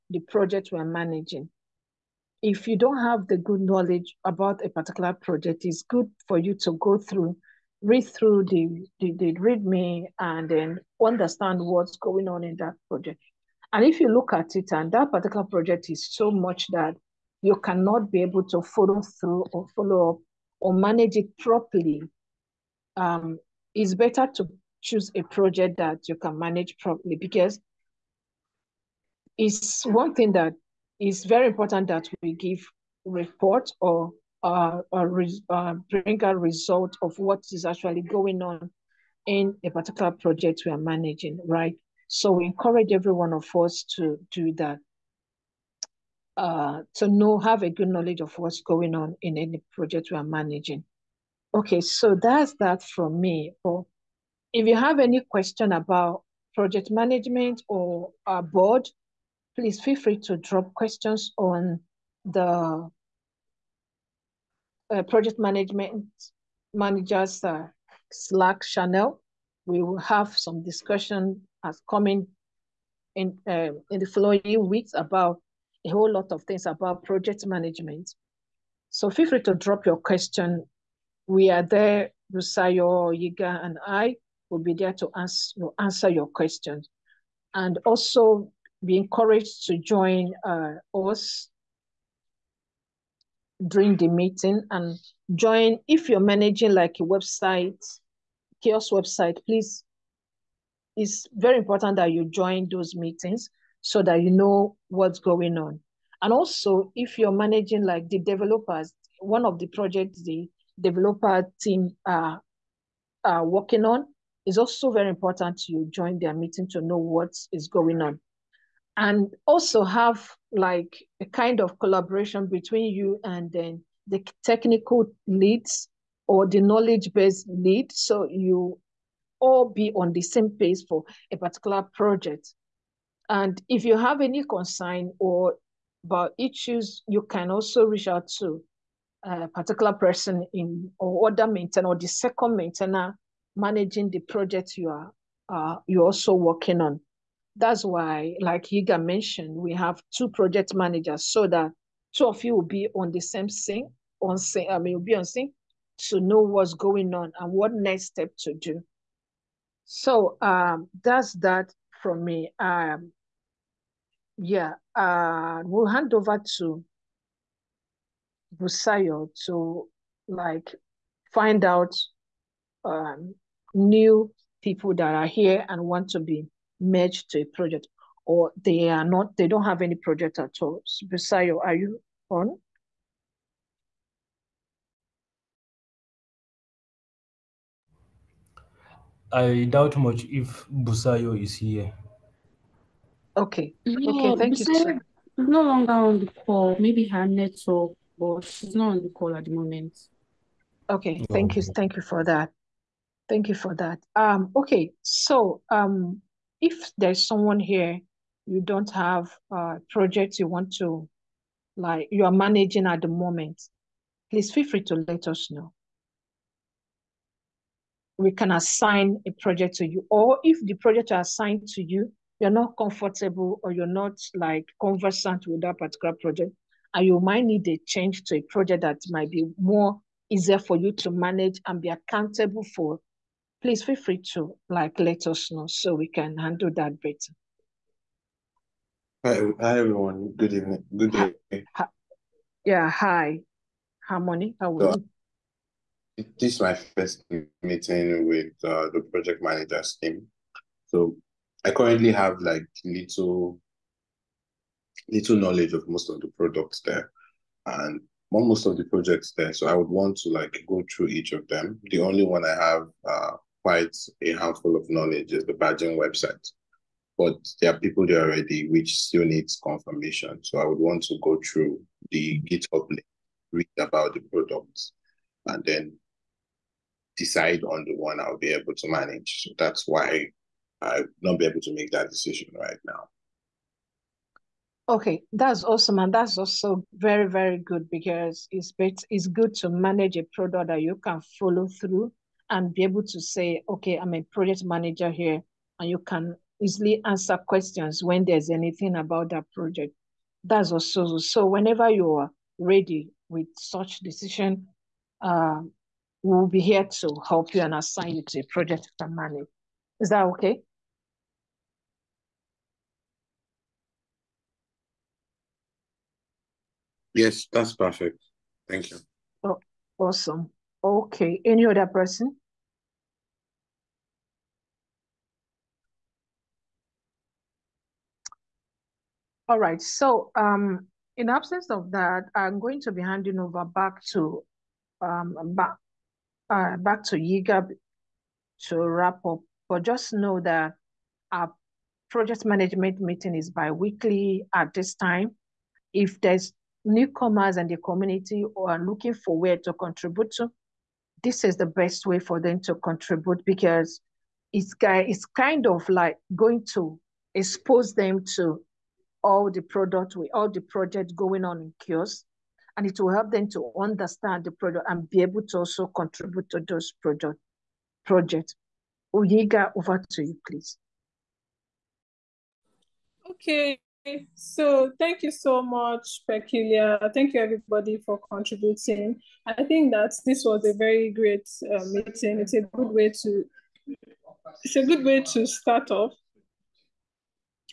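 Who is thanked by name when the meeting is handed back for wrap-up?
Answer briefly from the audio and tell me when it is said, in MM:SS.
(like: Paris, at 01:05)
Peculiar, at 06:16.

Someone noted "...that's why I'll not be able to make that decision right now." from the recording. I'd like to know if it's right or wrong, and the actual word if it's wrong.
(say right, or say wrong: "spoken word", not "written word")
right.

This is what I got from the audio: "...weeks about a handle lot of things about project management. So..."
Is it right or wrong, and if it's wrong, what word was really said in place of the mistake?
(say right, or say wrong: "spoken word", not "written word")
wrong: "whole", not "handle".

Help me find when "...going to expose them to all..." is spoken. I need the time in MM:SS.
05:56.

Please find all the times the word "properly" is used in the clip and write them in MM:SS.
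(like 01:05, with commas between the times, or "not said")
00:21, 00:26.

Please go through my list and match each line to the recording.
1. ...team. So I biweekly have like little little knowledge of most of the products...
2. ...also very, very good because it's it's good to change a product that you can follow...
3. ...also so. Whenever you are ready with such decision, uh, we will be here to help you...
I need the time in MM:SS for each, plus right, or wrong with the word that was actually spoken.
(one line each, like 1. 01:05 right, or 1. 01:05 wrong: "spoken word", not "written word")
1. 04:10 wrong: "currently", not "biweekly"
2. 04:46 wrong: "manage", not "change"
3. 05:00 right.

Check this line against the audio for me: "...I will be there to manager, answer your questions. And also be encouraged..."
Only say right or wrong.
wrong.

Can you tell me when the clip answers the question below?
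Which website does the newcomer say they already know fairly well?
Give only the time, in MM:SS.
04:25.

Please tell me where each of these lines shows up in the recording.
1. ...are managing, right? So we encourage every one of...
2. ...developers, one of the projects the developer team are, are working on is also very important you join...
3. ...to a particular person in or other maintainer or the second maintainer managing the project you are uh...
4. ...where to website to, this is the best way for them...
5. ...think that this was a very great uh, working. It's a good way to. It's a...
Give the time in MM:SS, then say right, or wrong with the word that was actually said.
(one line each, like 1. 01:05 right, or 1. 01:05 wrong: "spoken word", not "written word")
1. 00:40 right
2. 01:48 right
3. 02:18 right
4. 05:49 wrong: "contribute", not "website"
5. 06:19 wrong: "meeting", not "working".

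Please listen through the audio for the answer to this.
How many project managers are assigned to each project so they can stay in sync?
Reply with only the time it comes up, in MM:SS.
02:30.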